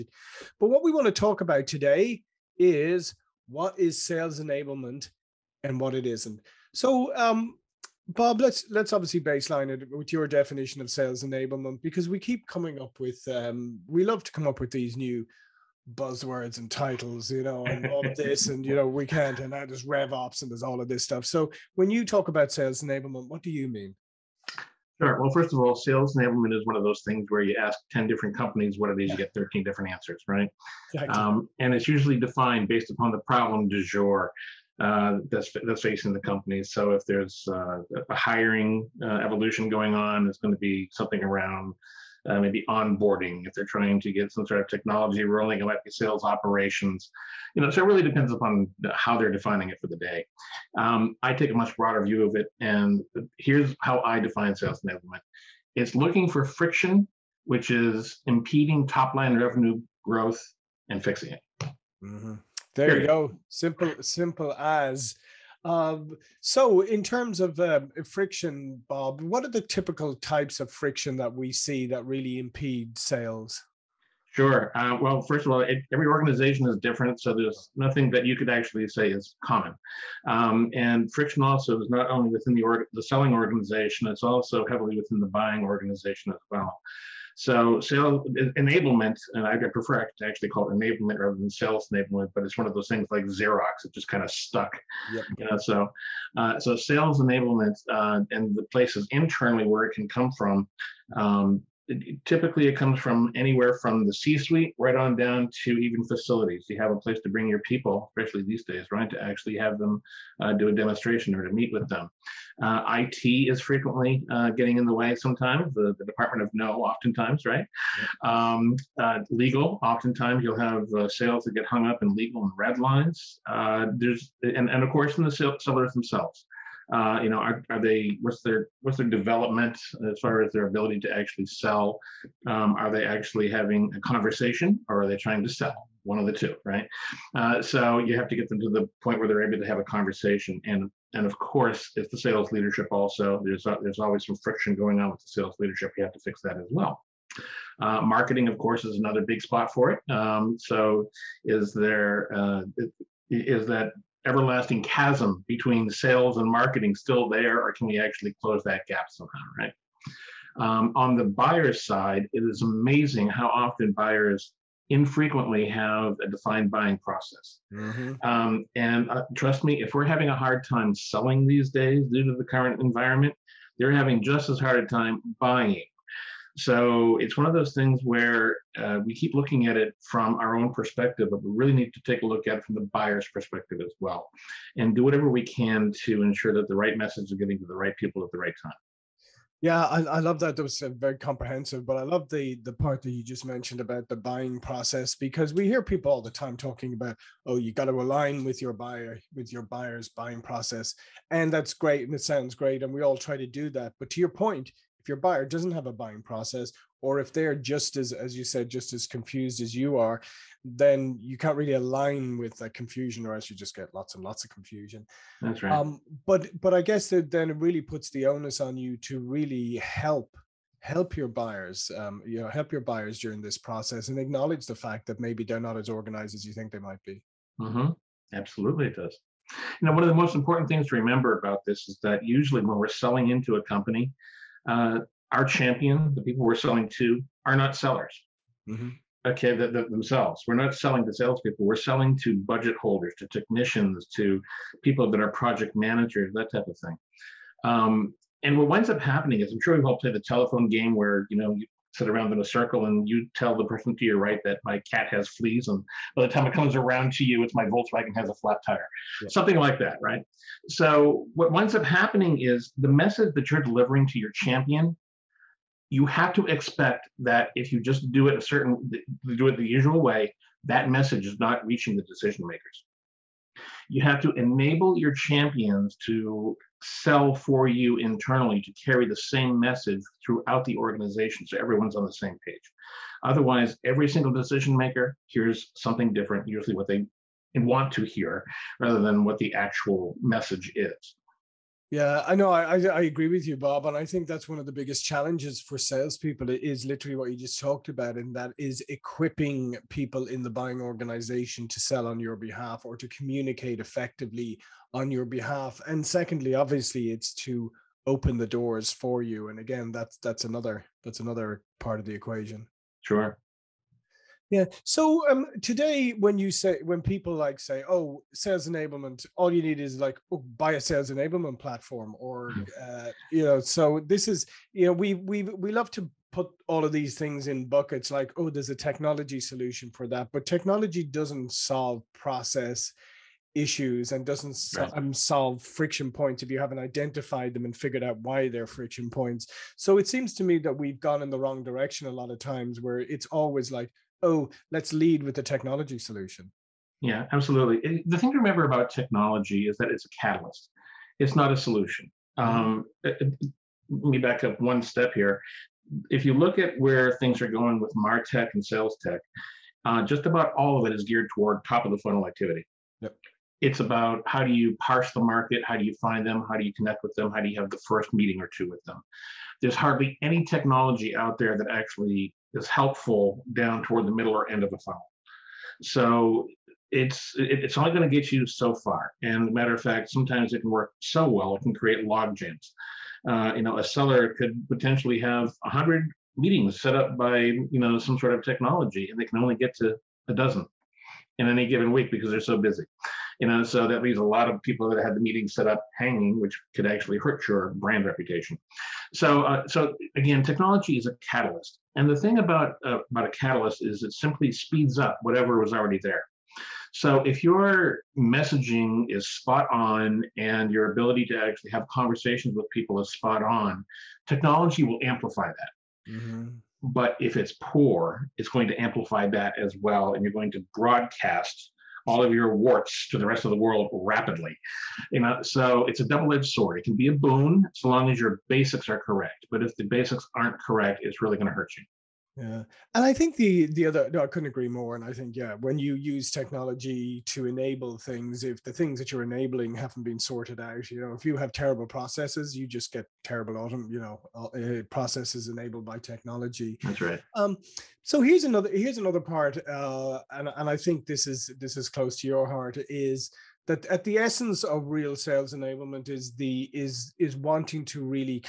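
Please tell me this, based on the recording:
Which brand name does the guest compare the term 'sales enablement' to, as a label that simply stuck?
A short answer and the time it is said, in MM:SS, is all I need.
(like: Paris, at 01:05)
Xerox, at 01:33.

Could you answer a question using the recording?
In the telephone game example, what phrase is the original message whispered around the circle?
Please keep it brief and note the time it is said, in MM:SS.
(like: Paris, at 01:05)
My cat has fleas, at 04:14.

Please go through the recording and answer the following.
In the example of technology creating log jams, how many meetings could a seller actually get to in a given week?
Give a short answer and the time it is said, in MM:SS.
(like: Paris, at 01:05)
12, at 06:30.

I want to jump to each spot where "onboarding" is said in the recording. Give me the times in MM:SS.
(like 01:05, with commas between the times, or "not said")
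00:42.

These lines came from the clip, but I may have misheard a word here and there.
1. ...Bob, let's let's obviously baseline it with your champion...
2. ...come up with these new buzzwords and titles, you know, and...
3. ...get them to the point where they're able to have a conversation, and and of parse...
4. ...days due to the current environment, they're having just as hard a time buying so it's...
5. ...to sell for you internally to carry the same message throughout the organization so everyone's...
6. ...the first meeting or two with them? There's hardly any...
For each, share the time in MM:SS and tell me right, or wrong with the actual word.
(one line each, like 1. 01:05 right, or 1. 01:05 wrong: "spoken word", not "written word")
1. 00:08 wrong: "definition", not "champion"
2. 00:14 right
3. 02:18 wrong: "course", not "parse"
4. 02:51 right
5. 04:36 right
6. 06:07 right.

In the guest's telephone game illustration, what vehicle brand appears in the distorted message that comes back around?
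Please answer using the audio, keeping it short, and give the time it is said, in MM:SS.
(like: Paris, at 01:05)
Volkswagen, at 04:17.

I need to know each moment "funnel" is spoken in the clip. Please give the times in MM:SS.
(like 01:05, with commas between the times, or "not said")
06:01, 06:14.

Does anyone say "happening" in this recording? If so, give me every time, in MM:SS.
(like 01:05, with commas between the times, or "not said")
04:09, 04:21.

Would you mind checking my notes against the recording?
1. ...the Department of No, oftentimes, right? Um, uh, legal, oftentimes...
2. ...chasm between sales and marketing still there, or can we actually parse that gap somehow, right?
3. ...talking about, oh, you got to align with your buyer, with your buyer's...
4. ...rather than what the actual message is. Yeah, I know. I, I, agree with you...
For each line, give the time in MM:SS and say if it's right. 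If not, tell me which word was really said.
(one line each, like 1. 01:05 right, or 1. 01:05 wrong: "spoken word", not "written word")
1. 01:55 right
2. 02:34 wrong: "close", not "parse"
3. 03:16 right
4. 04:48 right.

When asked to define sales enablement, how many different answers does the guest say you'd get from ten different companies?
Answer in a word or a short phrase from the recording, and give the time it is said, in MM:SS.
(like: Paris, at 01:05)
13, at 00:29.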